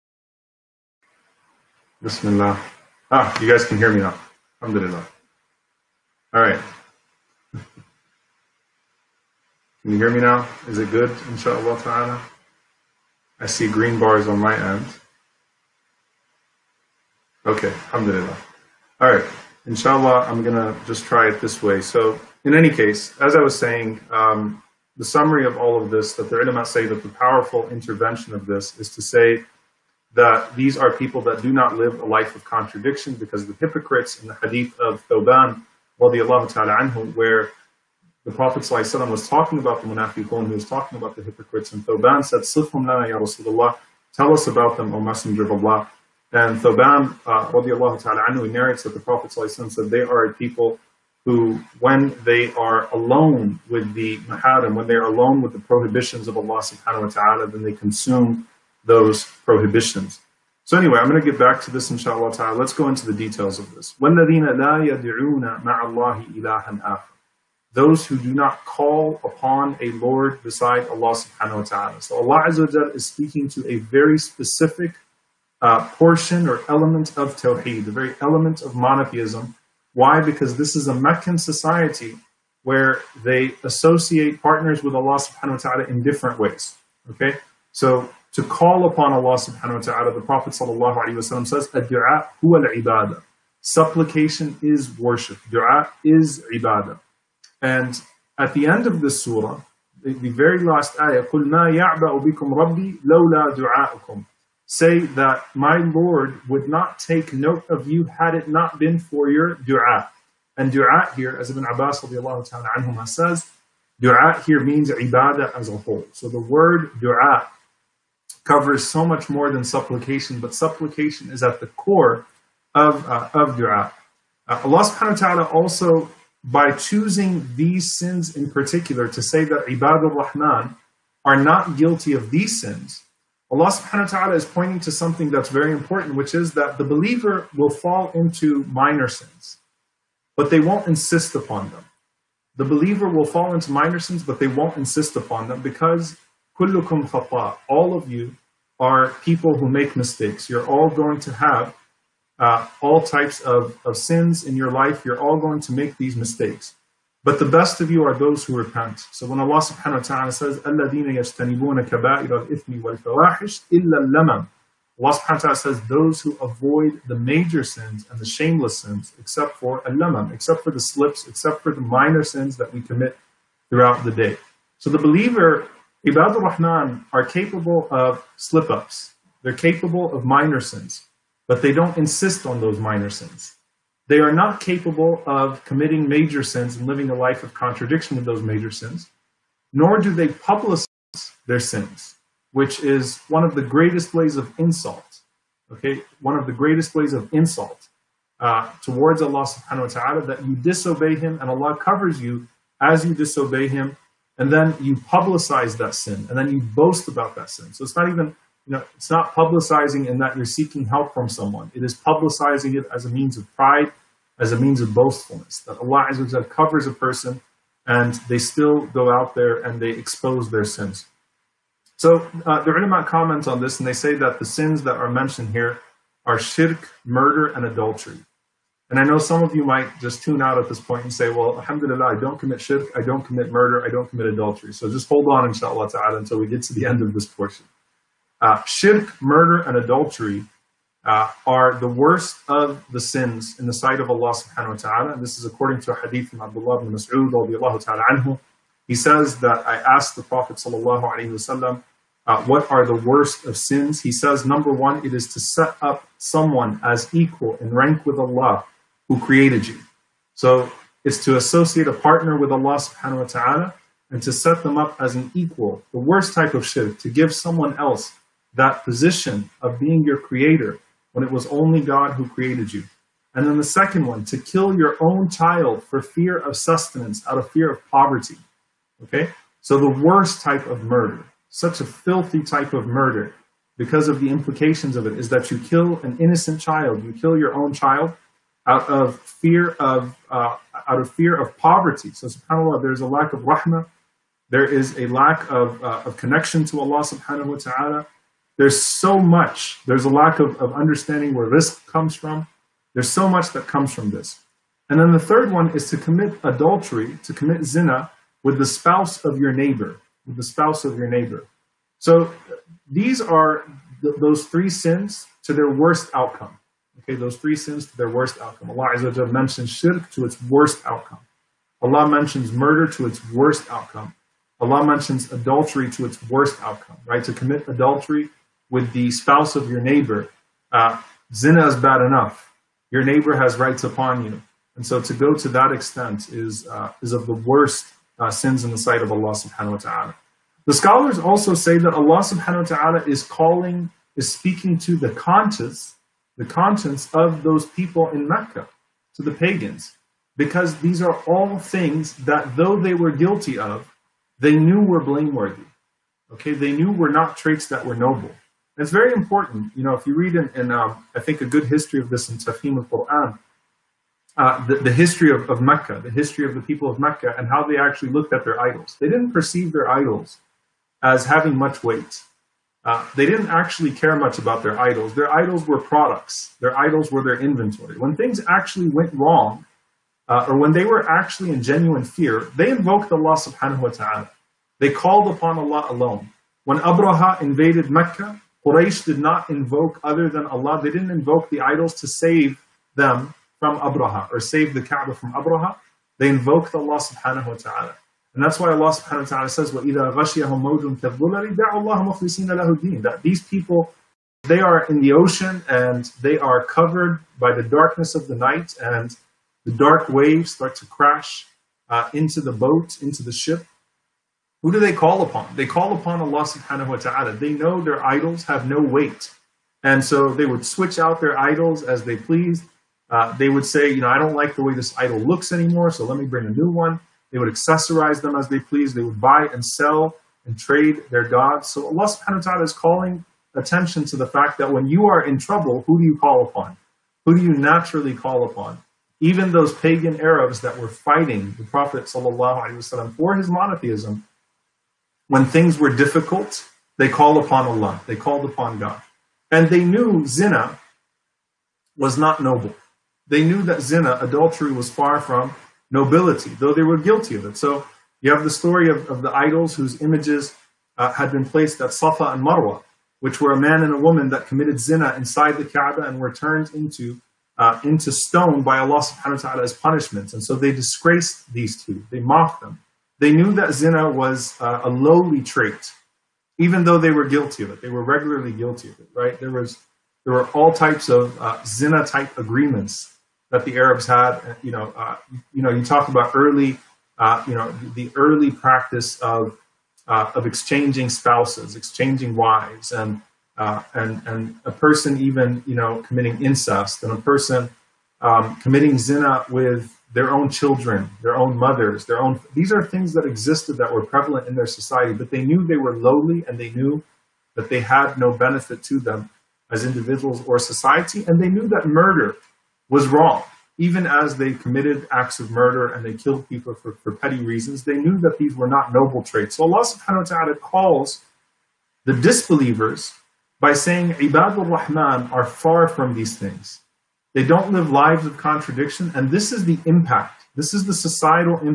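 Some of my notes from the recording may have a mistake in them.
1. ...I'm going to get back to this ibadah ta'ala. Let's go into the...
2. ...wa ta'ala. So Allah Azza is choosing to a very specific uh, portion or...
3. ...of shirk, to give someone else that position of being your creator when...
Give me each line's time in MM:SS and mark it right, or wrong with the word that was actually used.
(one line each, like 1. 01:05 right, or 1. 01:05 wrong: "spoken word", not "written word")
1. 01:00 wrong: "inshallah", not "ibadah"
2. 01:11 wrong: "speaking", not "choosing"
3. 04:26 right.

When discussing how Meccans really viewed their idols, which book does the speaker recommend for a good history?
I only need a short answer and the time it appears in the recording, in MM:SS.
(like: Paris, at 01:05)
Tafhim al-Qur'an, at 06:02.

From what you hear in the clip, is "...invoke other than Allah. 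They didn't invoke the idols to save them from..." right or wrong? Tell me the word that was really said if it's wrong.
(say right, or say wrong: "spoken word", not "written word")
right.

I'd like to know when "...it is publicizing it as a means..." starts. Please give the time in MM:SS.
03:31.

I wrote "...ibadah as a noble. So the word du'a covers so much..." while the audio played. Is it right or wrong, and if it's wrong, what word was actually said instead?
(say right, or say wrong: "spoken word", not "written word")
wrong: "whole", not "noble".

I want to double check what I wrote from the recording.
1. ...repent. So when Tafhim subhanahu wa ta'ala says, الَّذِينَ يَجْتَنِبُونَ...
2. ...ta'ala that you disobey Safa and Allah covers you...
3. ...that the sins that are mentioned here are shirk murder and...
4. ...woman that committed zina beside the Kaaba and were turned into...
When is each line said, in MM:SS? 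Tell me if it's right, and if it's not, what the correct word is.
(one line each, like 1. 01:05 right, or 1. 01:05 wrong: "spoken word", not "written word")
1. 02:38 wrong: "Allah", not "Tafhim"
2. 03:19 wrong: "Him", not "Safa"
3. 03:44 right
4. 07:43 wrong: "inside", not "beside".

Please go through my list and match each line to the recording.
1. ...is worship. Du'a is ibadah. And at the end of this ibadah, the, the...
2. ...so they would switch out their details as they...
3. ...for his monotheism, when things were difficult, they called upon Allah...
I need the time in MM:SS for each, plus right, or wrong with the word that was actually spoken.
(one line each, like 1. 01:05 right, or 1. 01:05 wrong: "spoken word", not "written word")
1. 01:34 wrong: "surah", not "ibadah"
2. 07:00 wrong: "idols", not "details"
3. 07:23 right.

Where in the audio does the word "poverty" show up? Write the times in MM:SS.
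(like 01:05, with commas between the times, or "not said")
04:37, 04:51.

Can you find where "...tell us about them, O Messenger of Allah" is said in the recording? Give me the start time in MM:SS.
00:44.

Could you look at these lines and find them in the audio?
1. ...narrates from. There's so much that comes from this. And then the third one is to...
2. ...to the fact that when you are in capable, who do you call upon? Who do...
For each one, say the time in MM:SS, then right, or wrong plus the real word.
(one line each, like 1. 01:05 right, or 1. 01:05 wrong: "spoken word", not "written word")
1. 05:01 wrong: "comes", not "narrates"
2. 07:14 wrong: "trouble", not "capable".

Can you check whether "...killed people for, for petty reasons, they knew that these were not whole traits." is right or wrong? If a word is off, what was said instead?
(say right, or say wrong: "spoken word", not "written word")
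wrong: "noble", not "whole".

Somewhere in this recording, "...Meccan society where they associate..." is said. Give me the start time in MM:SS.
01:20.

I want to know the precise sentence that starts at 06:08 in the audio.
They didn't perceive their idols as having much weight.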